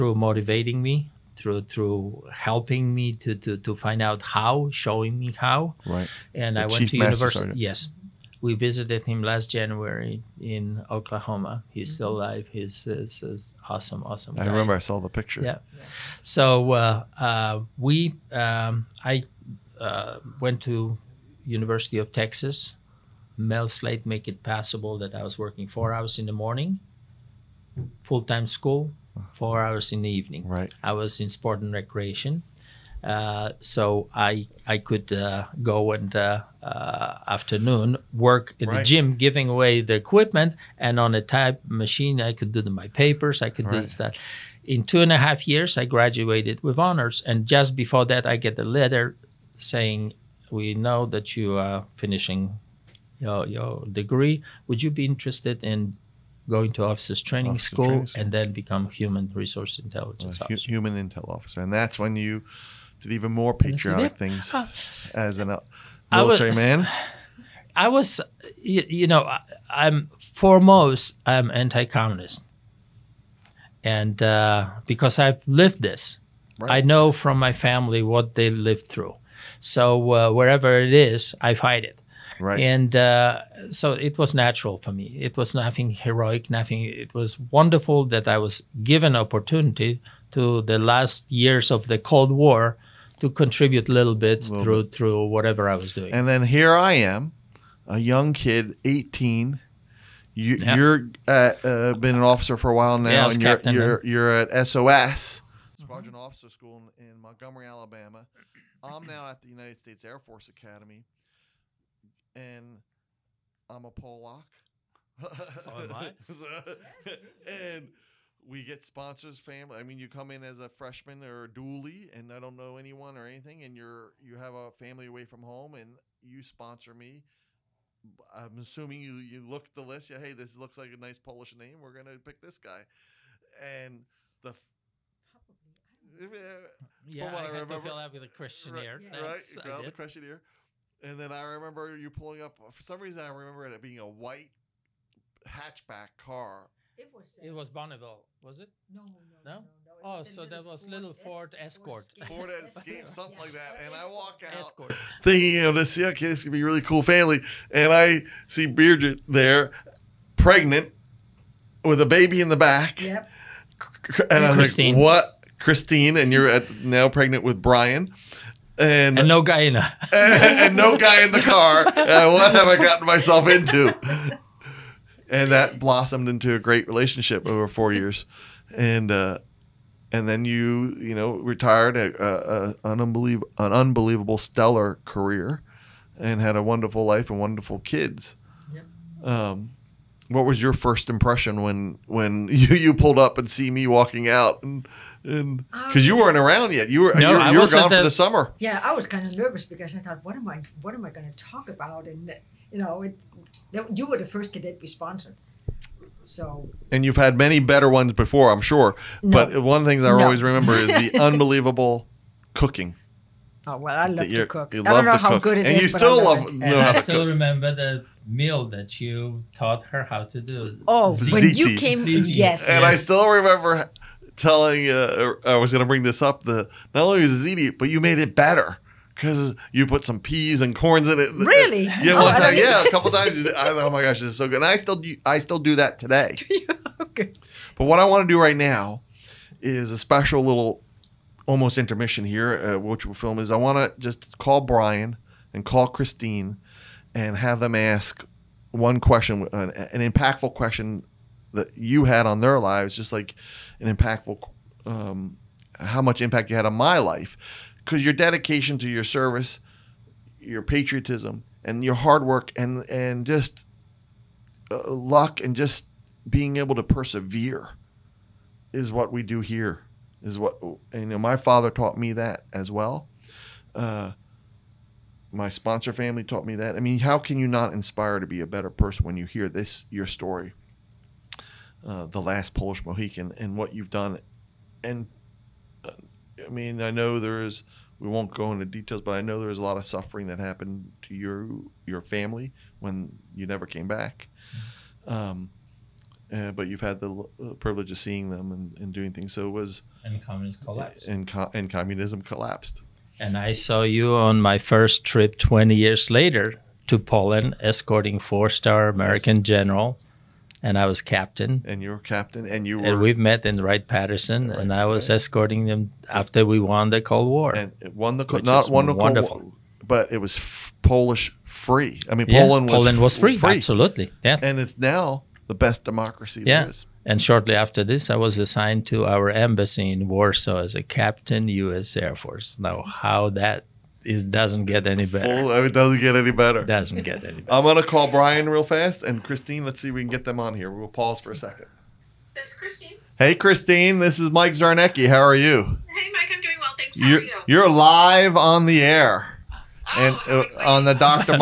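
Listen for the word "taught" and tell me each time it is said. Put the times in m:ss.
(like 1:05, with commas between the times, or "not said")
3:39, 4:31, 4:36.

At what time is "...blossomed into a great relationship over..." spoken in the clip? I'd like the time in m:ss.
2:55.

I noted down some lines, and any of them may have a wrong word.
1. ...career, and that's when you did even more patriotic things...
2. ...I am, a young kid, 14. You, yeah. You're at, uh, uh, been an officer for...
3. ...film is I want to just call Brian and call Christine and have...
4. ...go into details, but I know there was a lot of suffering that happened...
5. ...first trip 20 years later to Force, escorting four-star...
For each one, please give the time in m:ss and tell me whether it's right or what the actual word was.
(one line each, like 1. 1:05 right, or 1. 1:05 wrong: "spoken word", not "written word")
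1. 1:01 wrong: "officer", not "career"
2. 1:36 wrong: "18", not "14"
3. 4:03 right
4. 4:48 right
5. 5:04 wrong: "Poland", not "Force".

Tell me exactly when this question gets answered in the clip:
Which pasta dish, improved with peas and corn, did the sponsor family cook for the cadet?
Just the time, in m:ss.
3:47.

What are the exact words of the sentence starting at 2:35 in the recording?
thinking, you know, this okay, this could be a really cool family.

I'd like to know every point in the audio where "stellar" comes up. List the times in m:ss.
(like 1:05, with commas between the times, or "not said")
3:04.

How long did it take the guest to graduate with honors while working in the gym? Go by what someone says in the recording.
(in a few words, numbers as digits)
2 and a half years.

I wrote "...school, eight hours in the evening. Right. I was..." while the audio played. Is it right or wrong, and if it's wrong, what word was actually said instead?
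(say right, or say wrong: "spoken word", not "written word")
wrong: "four", not "eight".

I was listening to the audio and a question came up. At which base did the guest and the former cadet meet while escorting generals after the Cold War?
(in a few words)
Wright Patterson.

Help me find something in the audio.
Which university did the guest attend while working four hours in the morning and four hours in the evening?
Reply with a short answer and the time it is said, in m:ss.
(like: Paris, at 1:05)
University of Texas, at 0:21.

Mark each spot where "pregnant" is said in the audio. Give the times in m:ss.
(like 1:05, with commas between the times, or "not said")
2:40, 2:47.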